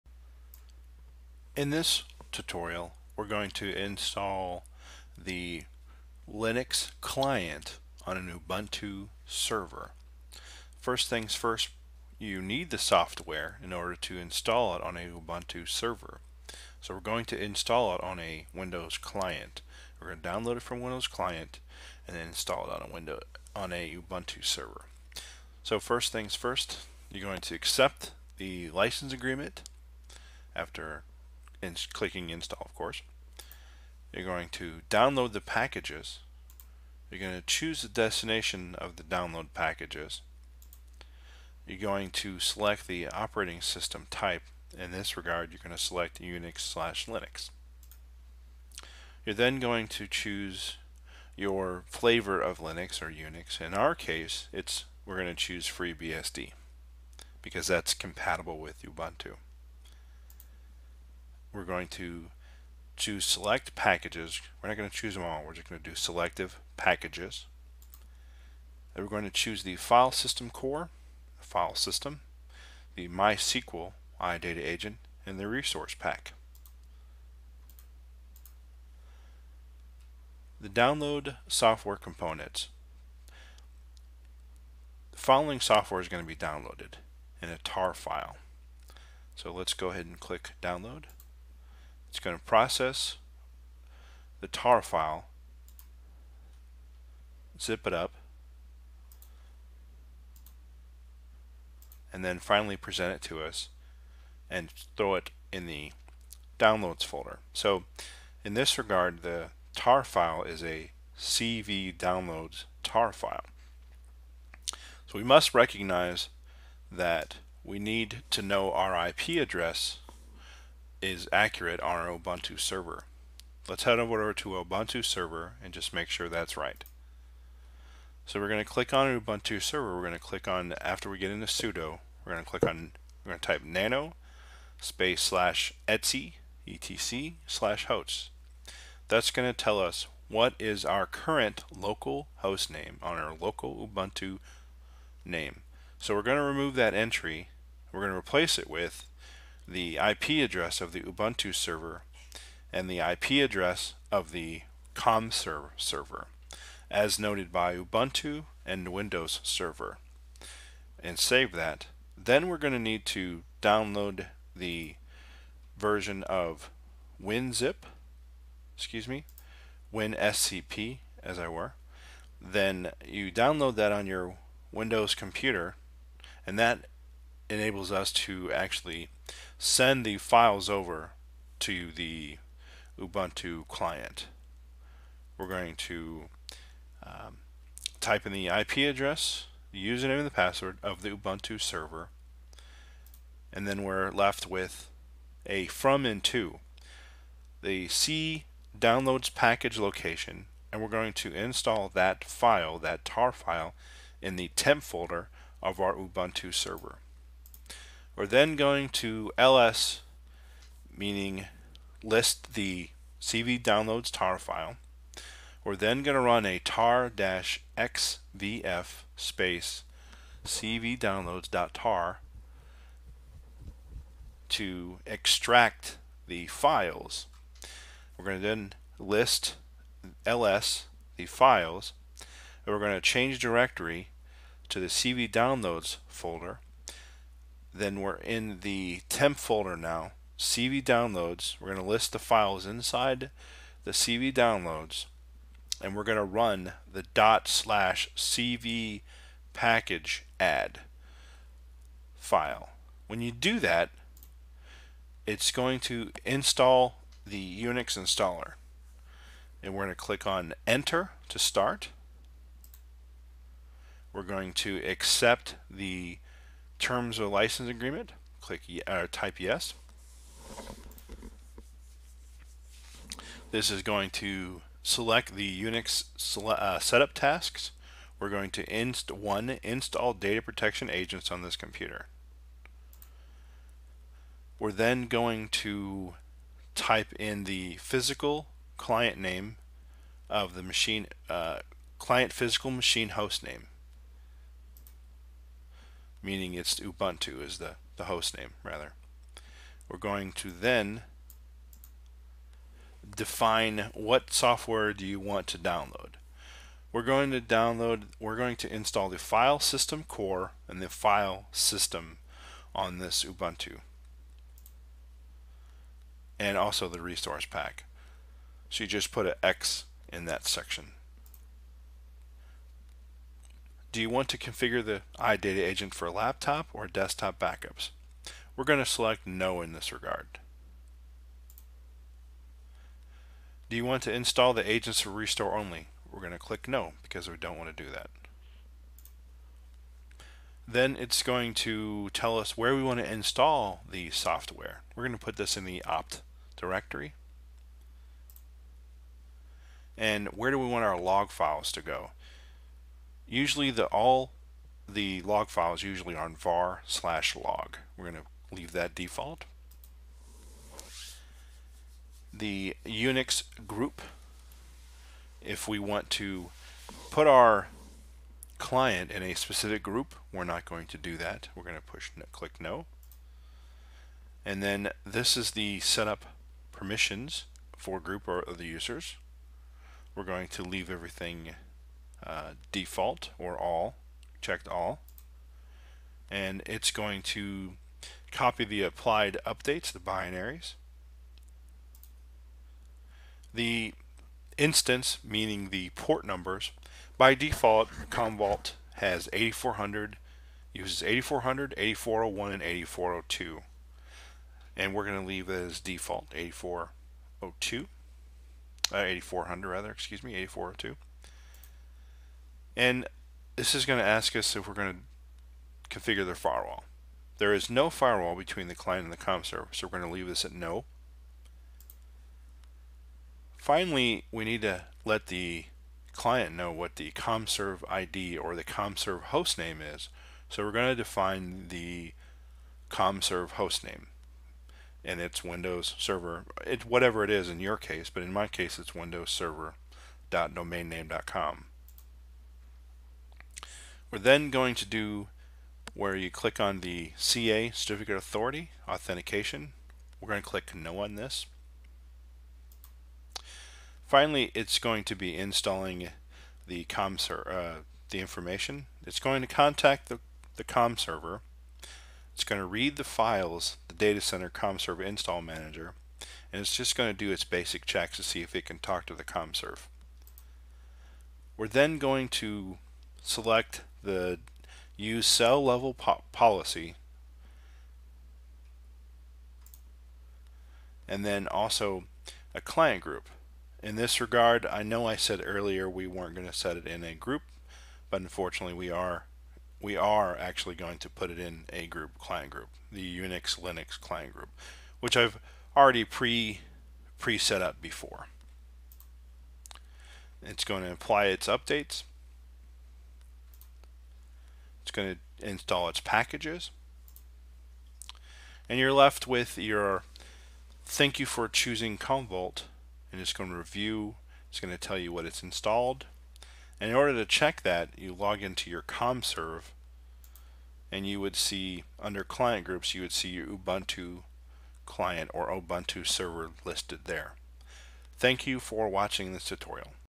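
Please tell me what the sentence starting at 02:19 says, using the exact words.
That's going to tell us what is our current local host name on our local Ubuntu name.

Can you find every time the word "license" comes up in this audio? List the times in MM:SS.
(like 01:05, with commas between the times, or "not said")
00:28, 04:27.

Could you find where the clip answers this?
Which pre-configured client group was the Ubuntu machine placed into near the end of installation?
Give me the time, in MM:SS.
08:13.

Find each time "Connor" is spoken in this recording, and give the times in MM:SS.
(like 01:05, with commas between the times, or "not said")
not said.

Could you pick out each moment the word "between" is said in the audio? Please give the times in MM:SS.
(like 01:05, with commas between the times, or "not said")
06:58.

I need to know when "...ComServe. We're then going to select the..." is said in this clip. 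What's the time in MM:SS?
07:49.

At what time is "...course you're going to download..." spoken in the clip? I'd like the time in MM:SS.
00:32.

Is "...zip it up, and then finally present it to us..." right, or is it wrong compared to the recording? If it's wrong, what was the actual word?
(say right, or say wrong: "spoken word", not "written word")
right.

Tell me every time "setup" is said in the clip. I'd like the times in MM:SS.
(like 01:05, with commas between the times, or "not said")
04:36, 06:15.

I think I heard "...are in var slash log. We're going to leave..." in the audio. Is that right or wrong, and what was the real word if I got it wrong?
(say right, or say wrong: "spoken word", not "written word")
right.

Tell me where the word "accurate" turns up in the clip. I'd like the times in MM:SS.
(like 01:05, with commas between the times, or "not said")
02:01.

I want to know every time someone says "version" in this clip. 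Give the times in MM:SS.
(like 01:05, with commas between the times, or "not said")
02:45.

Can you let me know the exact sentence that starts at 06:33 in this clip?
The instance, meaning the port numbers, by default, Commvault has 8400, uses 8400, 8401, and 8402.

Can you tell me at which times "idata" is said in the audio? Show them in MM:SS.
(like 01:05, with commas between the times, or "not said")
01:14, 05:25.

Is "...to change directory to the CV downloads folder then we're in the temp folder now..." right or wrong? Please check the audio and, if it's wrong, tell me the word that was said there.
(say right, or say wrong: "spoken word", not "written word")
right.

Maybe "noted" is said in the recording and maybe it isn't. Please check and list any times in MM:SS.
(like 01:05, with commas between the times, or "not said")
02:37.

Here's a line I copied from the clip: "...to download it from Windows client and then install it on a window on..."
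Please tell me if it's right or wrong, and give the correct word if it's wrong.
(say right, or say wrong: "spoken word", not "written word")
right.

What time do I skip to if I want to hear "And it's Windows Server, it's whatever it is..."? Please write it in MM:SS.
07:15.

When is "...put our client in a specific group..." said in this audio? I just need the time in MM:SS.
06:07.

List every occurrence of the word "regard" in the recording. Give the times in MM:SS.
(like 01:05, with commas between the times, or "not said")
00:45, 01:48, 05:29, 08:04.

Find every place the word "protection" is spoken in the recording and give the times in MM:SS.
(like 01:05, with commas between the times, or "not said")
04:40.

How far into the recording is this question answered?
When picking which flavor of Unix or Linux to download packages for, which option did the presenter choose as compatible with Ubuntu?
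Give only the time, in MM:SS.
00:55.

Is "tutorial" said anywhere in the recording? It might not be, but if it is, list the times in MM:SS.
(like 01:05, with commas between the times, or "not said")
00:02, 08:49.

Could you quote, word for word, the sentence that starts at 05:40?
Then it's going to tell us where we want to install the software.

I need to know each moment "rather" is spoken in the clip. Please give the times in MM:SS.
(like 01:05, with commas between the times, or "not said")
04:58, 06:49.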